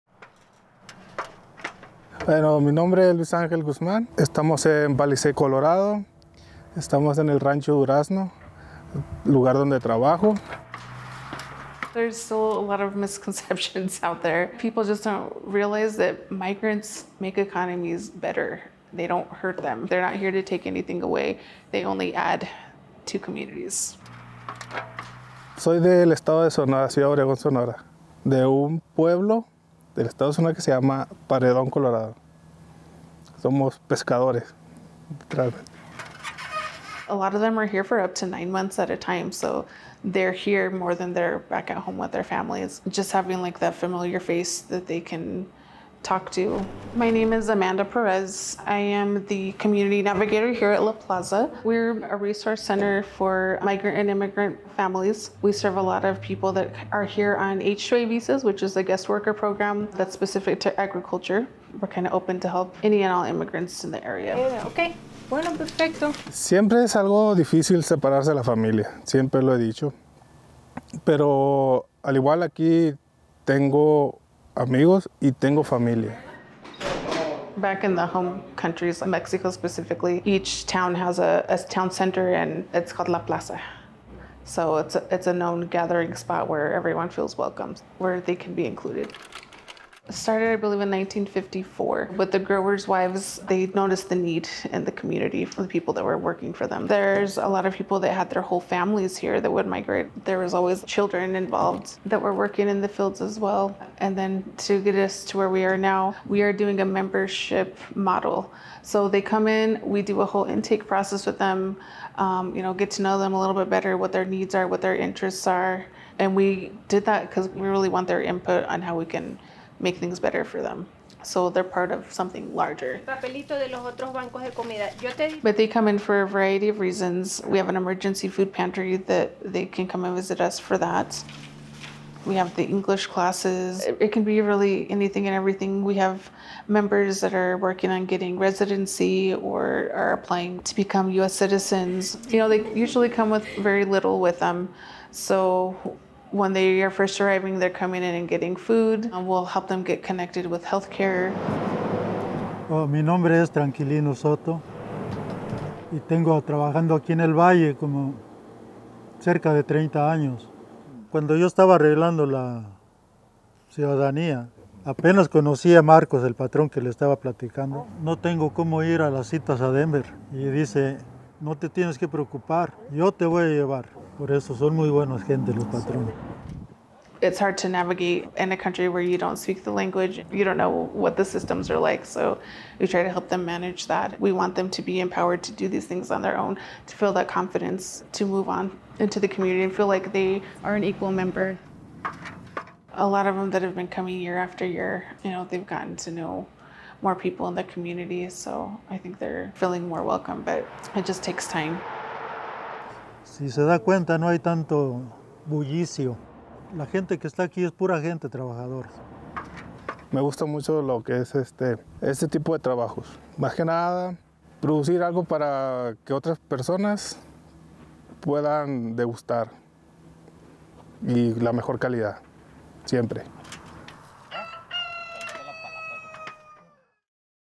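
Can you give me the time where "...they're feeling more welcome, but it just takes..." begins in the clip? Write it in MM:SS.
03:19.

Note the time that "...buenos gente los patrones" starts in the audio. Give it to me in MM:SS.
02:54.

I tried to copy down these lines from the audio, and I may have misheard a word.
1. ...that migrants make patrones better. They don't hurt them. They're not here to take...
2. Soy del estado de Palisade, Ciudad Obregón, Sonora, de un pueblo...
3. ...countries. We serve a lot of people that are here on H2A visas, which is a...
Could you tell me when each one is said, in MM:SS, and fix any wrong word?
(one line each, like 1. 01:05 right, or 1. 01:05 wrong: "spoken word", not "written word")
1. 00:15 wrong: "economies", not "patrones"
2. 00:25 wrong: "Sonora", not "Palisade"
3. 00:54 wrong: "families", not "countries".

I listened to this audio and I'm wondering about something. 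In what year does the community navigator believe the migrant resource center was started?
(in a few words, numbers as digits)
1954.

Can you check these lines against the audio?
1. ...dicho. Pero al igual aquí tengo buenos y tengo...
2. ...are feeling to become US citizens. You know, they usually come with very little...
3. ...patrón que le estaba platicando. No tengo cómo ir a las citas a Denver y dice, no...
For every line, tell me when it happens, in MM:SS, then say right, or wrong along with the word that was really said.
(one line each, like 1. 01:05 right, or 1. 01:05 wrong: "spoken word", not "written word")
1. 01:09 wrong: "amigos", not "buenos"
2. 02:19 wrong: "applying", not "feeling"
3. 02:46 right.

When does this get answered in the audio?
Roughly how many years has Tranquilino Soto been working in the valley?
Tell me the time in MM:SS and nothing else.
02:39.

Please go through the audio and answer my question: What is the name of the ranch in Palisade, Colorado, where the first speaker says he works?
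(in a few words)
Rancho Durazno.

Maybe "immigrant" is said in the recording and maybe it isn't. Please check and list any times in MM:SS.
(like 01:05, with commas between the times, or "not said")
00:54, 01:03.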